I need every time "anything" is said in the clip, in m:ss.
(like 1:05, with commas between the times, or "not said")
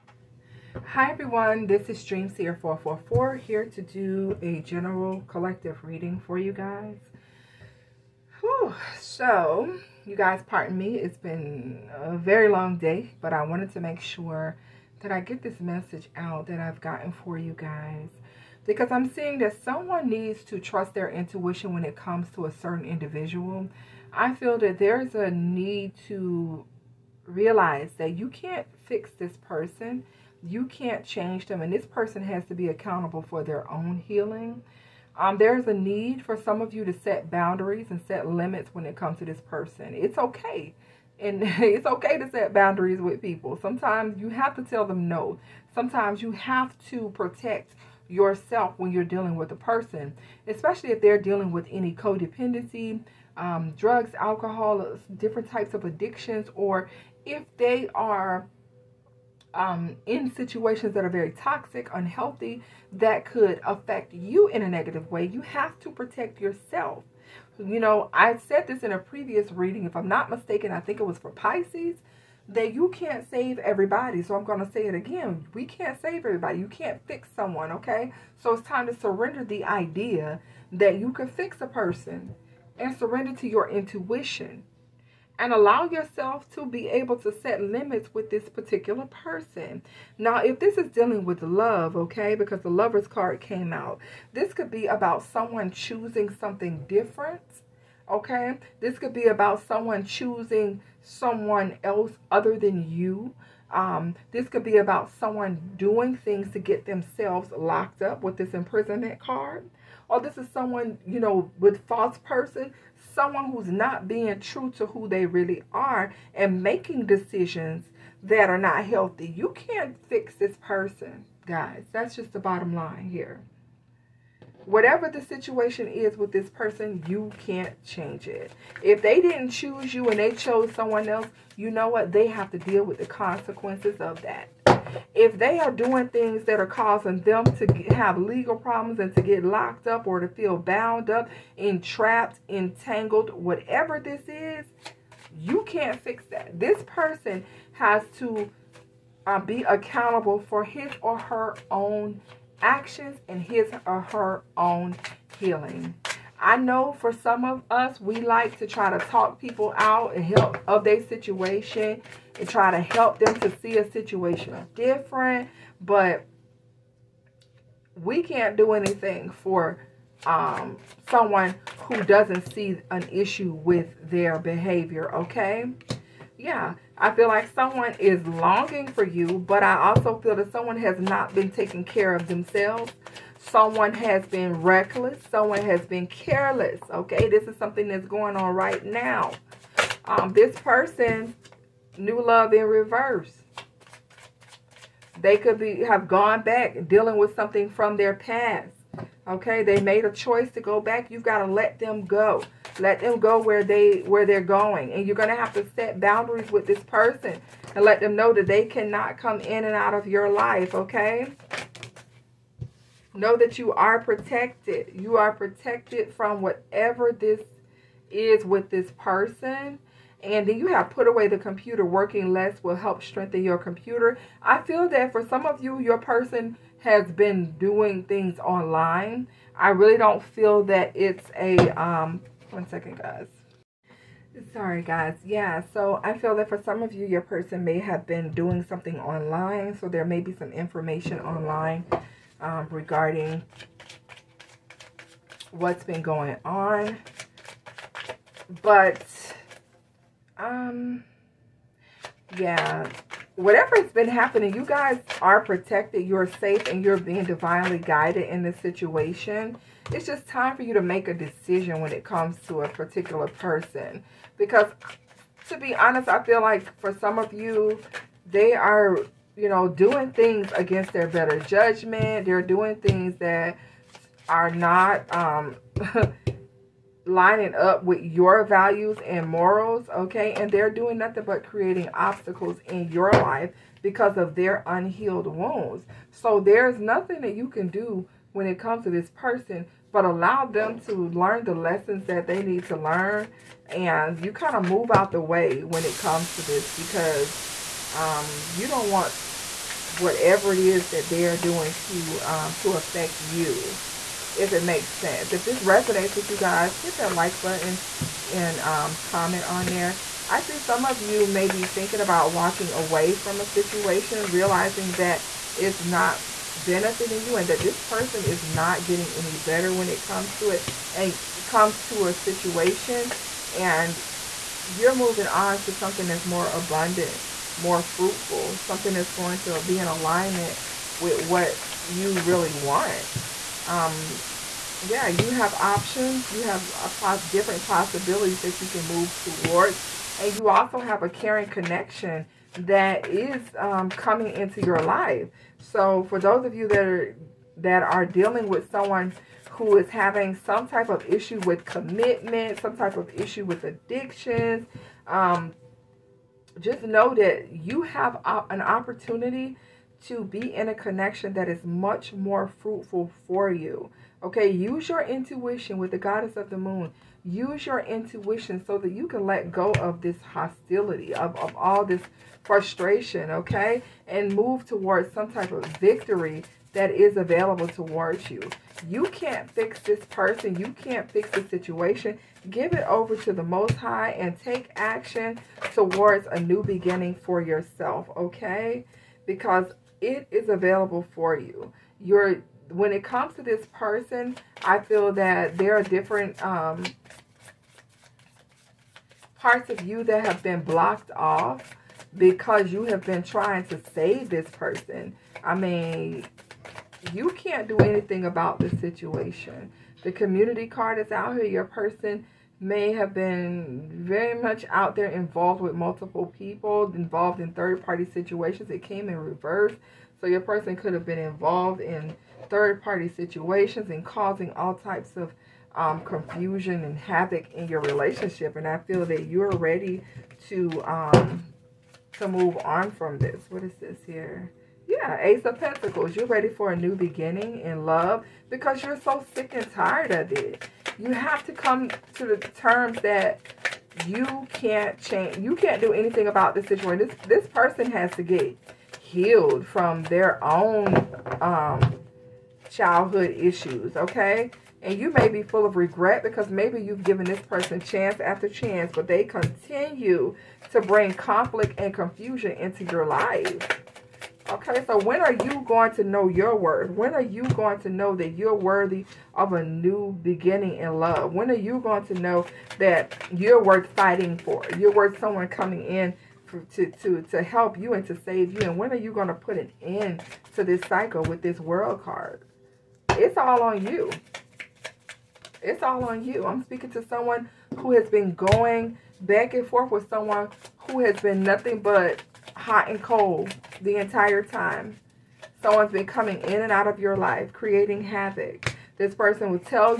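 2:48, 6:47, 7:25.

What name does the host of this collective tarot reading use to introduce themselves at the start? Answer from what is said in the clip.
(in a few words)
DreamSeer444.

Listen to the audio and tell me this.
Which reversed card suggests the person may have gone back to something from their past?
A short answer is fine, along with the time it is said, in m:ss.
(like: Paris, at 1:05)
new love, at 3:11.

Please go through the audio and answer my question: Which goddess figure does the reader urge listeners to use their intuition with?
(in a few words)
goddess of the moon.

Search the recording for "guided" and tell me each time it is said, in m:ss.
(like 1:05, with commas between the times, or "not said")
4:17.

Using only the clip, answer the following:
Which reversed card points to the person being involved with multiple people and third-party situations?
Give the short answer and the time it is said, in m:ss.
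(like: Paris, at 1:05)
community card, at 6:50.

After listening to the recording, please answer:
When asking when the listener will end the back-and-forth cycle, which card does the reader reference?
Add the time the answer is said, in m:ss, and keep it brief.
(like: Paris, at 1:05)
world card, at 8:01.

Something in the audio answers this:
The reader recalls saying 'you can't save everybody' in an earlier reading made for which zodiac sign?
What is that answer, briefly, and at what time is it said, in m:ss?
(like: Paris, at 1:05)
Pisces, at 1:11.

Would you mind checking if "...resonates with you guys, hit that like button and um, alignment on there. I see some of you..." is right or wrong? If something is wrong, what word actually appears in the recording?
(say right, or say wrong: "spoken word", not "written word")
wrong: "comment", not "alignment".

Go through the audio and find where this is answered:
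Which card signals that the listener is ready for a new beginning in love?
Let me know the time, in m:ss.
7:15.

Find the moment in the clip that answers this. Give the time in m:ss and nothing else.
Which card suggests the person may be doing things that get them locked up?
1:48.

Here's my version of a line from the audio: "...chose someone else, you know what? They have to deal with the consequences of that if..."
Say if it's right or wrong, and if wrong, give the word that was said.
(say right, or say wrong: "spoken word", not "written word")
right.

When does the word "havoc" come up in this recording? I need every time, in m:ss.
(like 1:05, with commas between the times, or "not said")
7:06, 8:18.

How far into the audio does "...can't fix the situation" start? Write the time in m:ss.
6:20.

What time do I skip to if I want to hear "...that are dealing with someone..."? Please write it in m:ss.
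5:47.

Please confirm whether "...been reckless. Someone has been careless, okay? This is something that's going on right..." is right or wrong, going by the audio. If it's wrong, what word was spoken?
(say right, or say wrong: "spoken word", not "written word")
right.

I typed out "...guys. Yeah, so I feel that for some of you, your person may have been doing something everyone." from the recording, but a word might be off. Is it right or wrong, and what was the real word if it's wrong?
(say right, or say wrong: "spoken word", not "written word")
wrong: "online", not "everyone".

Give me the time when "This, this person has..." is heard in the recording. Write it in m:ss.
7:27.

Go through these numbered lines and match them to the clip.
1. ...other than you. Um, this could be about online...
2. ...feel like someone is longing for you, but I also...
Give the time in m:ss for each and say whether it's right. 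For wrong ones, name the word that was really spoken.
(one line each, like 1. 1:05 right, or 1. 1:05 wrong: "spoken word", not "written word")
1. 1:42 wrong: "someone", not "online"
2. 2:57 right.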